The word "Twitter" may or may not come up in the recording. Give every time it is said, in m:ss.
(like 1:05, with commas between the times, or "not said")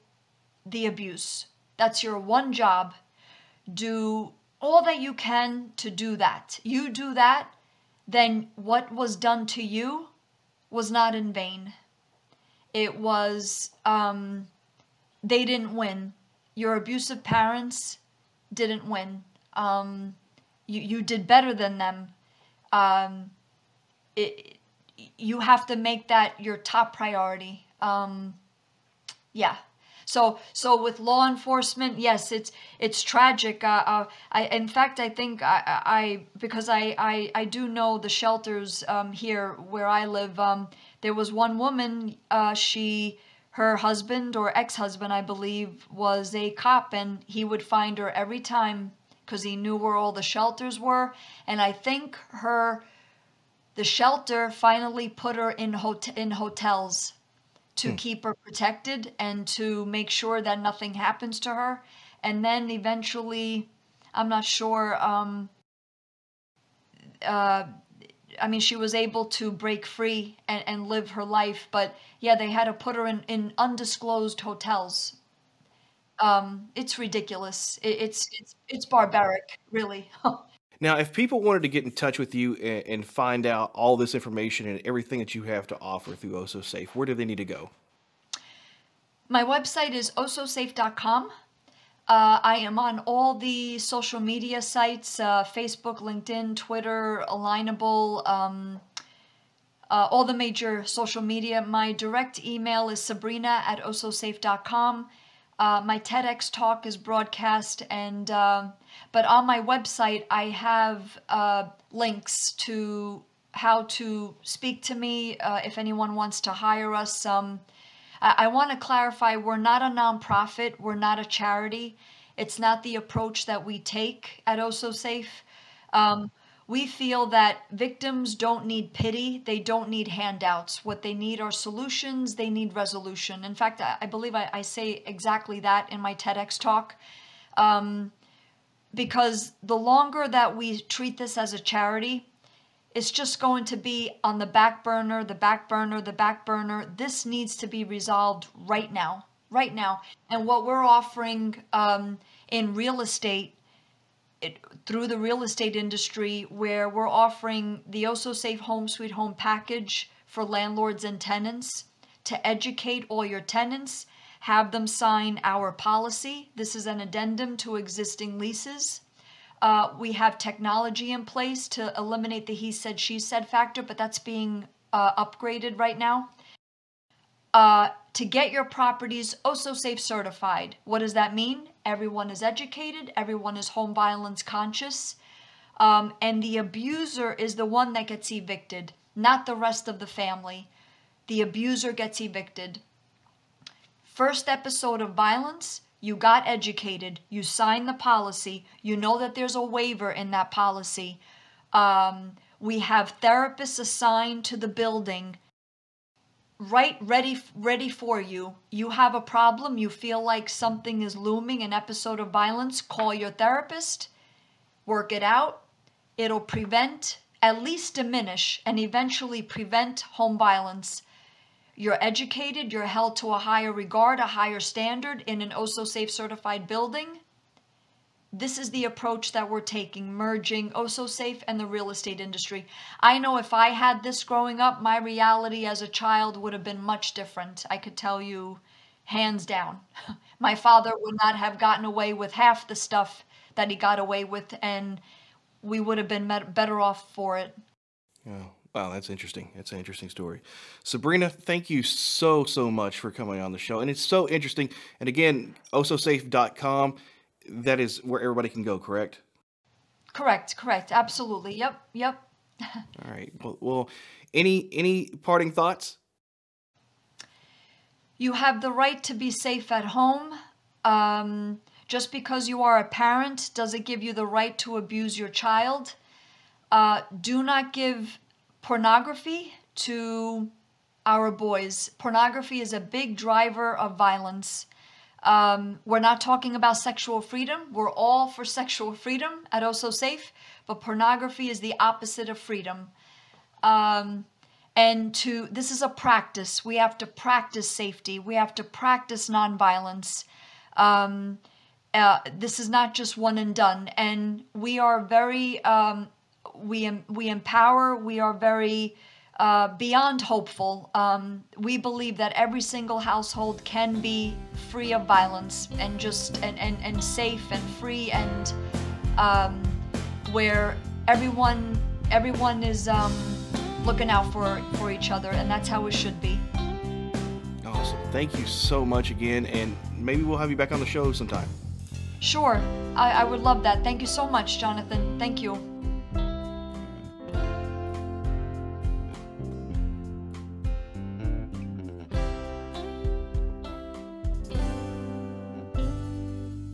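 1:36.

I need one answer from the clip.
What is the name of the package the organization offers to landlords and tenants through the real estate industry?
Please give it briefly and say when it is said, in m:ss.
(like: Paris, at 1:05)
Home Sweet Home, at 2:38.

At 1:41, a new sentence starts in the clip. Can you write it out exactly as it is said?
My direct email is sabrina at ossosafe.com.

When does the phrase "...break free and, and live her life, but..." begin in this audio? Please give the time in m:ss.
1:09.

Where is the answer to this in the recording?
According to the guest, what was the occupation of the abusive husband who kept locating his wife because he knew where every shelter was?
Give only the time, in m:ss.
0:46.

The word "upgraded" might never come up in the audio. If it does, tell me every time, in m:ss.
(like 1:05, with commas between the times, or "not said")
2:55.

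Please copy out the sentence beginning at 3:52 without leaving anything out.
I know if I had this growing up, my reality as a child would have been much different.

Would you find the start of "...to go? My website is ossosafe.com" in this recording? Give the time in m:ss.
1:27.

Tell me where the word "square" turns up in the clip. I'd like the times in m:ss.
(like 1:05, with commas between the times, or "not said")
not said.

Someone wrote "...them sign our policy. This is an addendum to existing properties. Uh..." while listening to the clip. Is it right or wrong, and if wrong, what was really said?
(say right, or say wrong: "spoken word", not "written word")
wrong: "leases", not "properties".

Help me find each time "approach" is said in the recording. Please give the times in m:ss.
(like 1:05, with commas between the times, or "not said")
2:02, 3:48.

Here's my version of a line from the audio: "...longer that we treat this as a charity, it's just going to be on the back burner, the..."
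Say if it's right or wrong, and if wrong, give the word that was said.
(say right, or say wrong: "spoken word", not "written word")
right.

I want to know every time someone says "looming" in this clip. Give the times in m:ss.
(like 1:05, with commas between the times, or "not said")
3:31.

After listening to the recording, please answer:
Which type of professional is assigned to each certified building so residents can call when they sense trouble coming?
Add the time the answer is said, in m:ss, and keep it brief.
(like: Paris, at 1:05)
Therapists, at 3:23.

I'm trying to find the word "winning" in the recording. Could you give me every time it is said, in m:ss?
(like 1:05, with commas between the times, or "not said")
not said.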